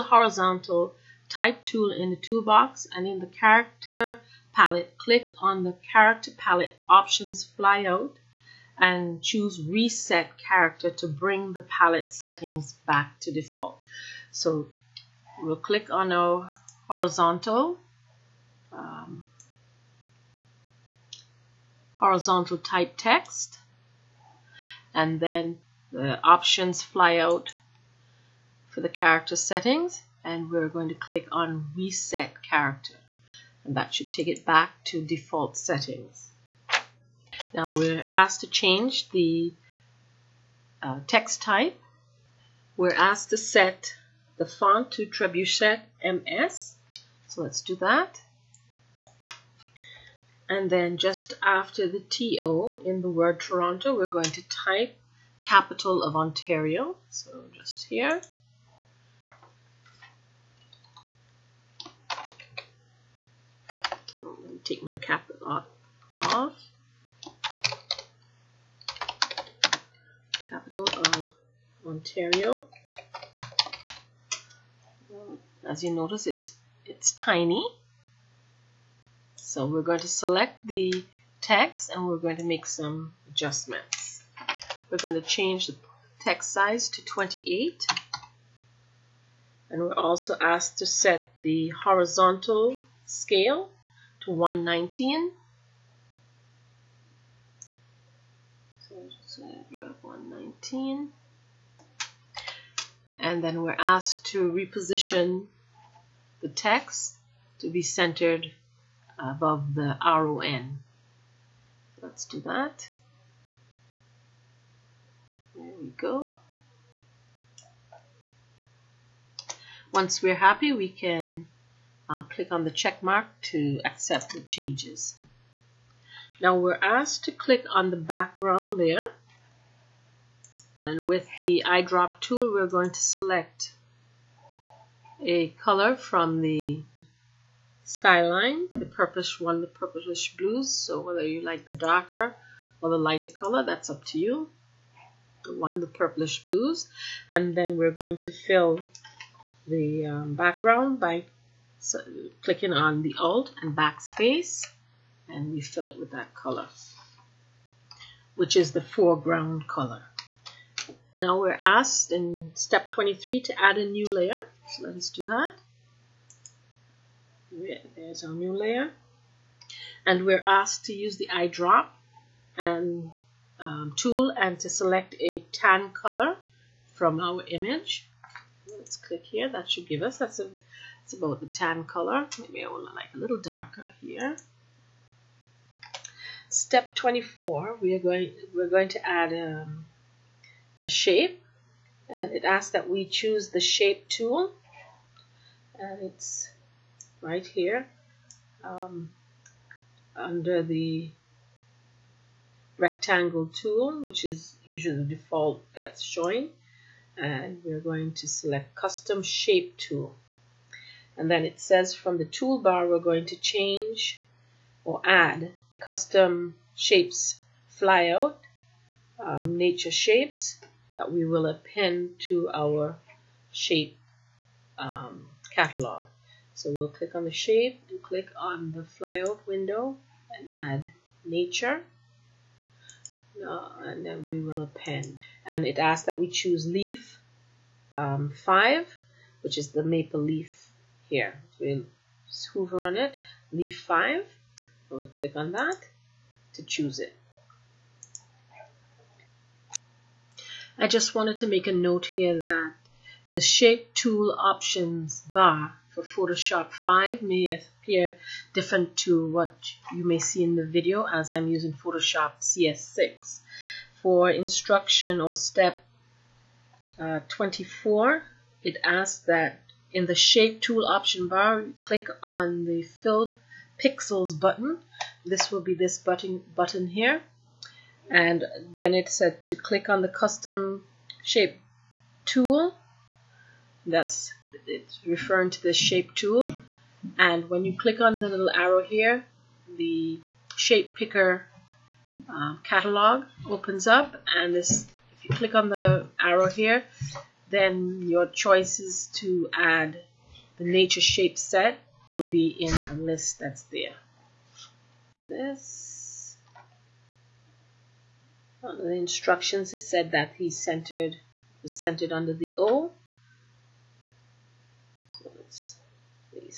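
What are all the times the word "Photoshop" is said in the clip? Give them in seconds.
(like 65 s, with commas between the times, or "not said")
256 s, 261 s.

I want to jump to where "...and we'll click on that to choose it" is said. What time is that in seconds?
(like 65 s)
244 s.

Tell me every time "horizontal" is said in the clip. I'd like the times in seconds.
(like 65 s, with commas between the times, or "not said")
0 s, 16 s, 21 s, 91 s.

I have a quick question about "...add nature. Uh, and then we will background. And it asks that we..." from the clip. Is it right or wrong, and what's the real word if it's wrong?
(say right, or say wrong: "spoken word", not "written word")
wrong: "append", not "background".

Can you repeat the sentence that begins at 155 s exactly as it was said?
And we fill it with that color, which is the foreground color.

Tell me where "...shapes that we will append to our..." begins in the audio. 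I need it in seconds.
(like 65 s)
219 s.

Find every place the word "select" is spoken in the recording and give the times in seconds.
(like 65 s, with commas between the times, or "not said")
80 s, 133 s, 174 s, 208 s.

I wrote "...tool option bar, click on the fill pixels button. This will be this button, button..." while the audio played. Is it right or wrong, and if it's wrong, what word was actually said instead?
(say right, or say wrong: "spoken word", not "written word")
right.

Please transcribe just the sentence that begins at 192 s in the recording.
Uh, it asks that we choose the shape tool.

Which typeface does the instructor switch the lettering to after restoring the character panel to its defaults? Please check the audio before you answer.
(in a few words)
Trebuchet MS.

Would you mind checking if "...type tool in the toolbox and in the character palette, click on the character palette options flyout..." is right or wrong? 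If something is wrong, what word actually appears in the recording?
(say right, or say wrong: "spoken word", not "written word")
right.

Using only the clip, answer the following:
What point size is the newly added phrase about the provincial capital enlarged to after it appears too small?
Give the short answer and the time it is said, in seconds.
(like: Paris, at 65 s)
28, at 87 s.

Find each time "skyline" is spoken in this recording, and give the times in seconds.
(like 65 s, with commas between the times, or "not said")
137 s.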